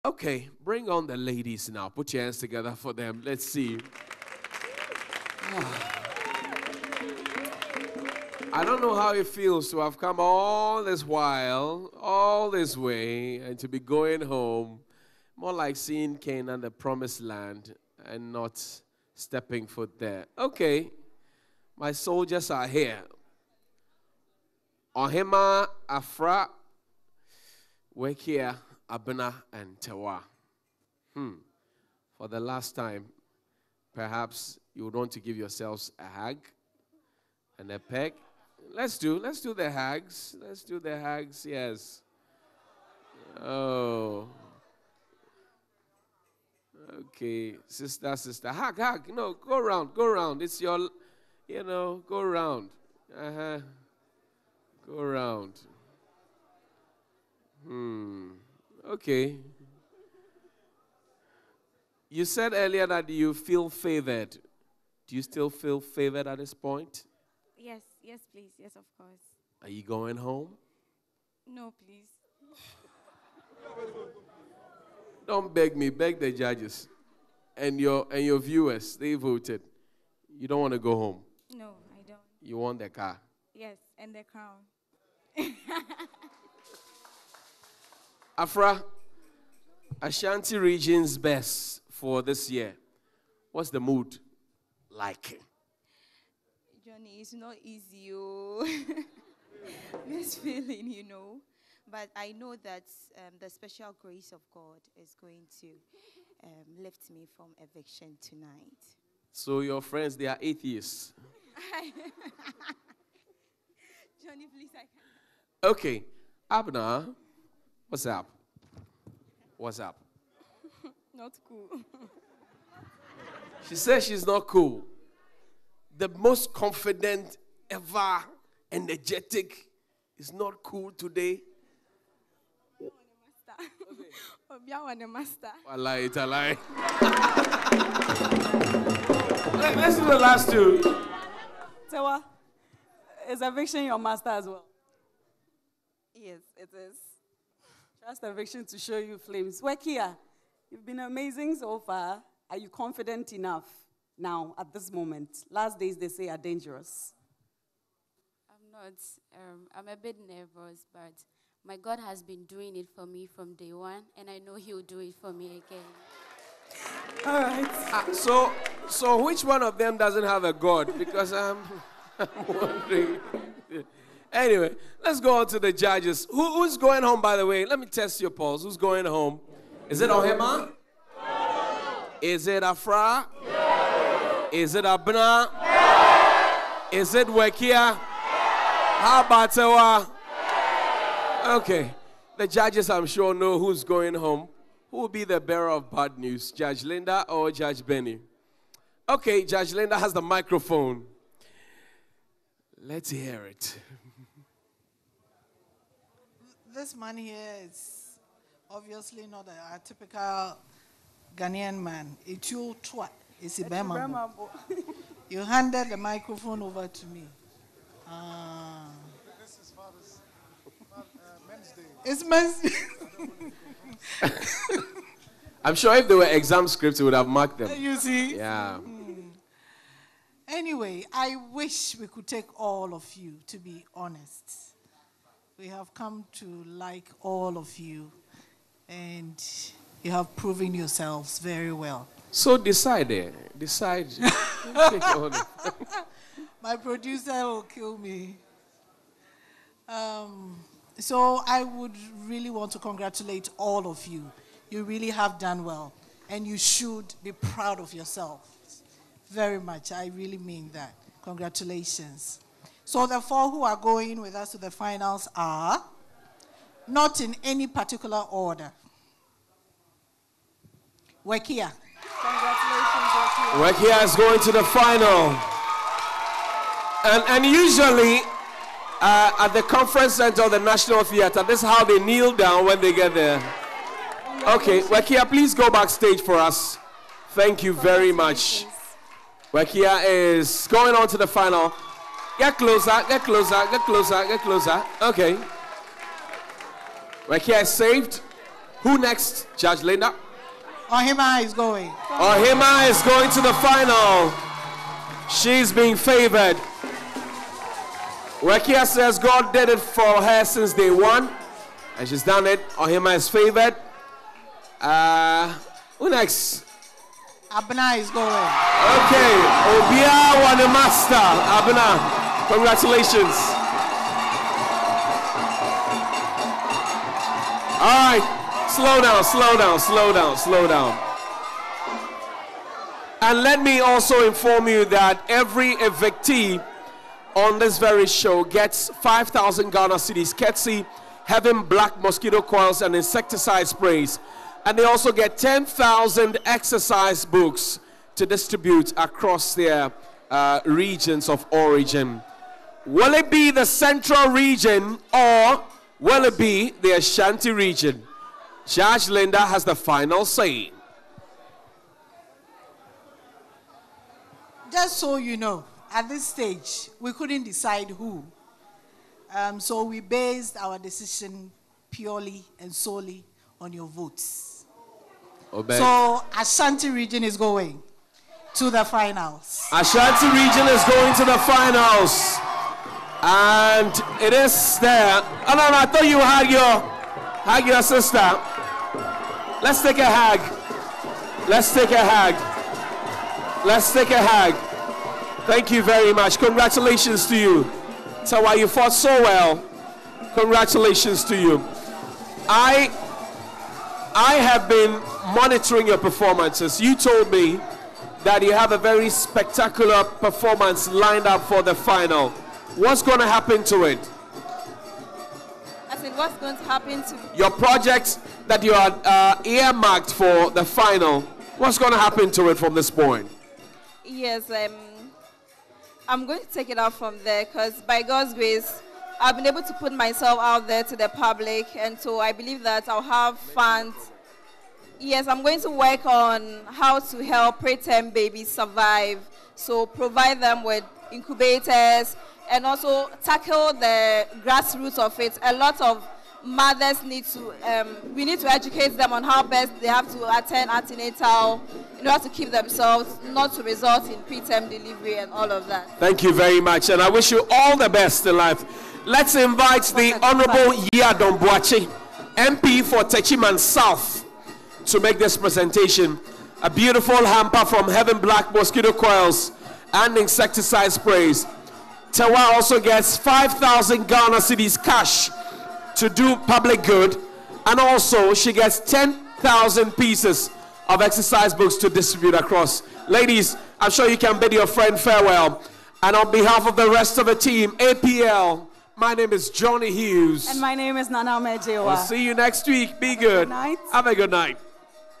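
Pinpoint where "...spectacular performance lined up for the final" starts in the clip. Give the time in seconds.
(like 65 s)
409 s.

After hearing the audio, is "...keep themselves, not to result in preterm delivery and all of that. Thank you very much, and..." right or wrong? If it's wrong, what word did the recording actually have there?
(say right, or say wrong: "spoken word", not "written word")
right.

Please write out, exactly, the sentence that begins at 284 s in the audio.
Okay, Wekia, please go backstage for us.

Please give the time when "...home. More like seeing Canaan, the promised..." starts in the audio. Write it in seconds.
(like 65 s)
14 s.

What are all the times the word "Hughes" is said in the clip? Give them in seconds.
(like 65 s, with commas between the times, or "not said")
489 s.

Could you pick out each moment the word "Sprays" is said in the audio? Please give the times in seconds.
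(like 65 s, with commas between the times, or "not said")
343 s, 470 s.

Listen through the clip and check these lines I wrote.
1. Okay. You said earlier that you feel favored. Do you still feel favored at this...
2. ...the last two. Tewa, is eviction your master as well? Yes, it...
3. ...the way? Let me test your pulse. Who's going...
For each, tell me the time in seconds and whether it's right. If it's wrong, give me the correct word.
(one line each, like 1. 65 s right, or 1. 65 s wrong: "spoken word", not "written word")
1. 58 s right
2. 140 s right
3. 177 s right.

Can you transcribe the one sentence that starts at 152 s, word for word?
Are you confident enough now at this moment?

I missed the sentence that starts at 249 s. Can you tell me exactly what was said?
Um, so I would really want to congratulate all of you.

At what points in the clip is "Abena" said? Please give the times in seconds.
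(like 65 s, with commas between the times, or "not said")
28 s, 116 s, 184 s, 317 s, 321 s.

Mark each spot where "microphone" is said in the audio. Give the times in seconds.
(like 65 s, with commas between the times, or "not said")
200 s, 215 s.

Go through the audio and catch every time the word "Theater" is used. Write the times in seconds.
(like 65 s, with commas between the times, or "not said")
281 s.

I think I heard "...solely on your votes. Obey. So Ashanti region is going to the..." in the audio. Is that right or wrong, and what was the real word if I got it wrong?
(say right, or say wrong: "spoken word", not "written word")
right.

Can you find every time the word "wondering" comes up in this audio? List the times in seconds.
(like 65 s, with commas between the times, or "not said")
172 s.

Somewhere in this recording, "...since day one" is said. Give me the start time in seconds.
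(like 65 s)
310 s.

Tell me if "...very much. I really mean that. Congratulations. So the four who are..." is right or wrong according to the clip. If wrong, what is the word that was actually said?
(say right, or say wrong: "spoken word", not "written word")
right.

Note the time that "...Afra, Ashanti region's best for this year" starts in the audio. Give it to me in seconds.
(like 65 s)
88 s.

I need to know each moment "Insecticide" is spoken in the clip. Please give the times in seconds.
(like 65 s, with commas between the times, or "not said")
342 s, 470 s.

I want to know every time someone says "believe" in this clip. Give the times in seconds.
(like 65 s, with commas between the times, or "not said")
432 s.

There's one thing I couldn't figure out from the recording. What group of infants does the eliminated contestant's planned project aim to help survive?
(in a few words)
Preterm babies.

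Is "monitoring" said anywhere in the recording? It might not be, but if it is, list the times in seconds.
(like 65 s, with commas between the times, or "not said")
405 s.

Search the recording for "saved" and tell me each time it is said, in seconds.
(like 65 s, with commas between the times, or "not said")
297 s.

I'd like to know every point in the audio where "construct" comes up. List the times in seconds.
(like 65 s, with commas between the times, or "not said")
not said.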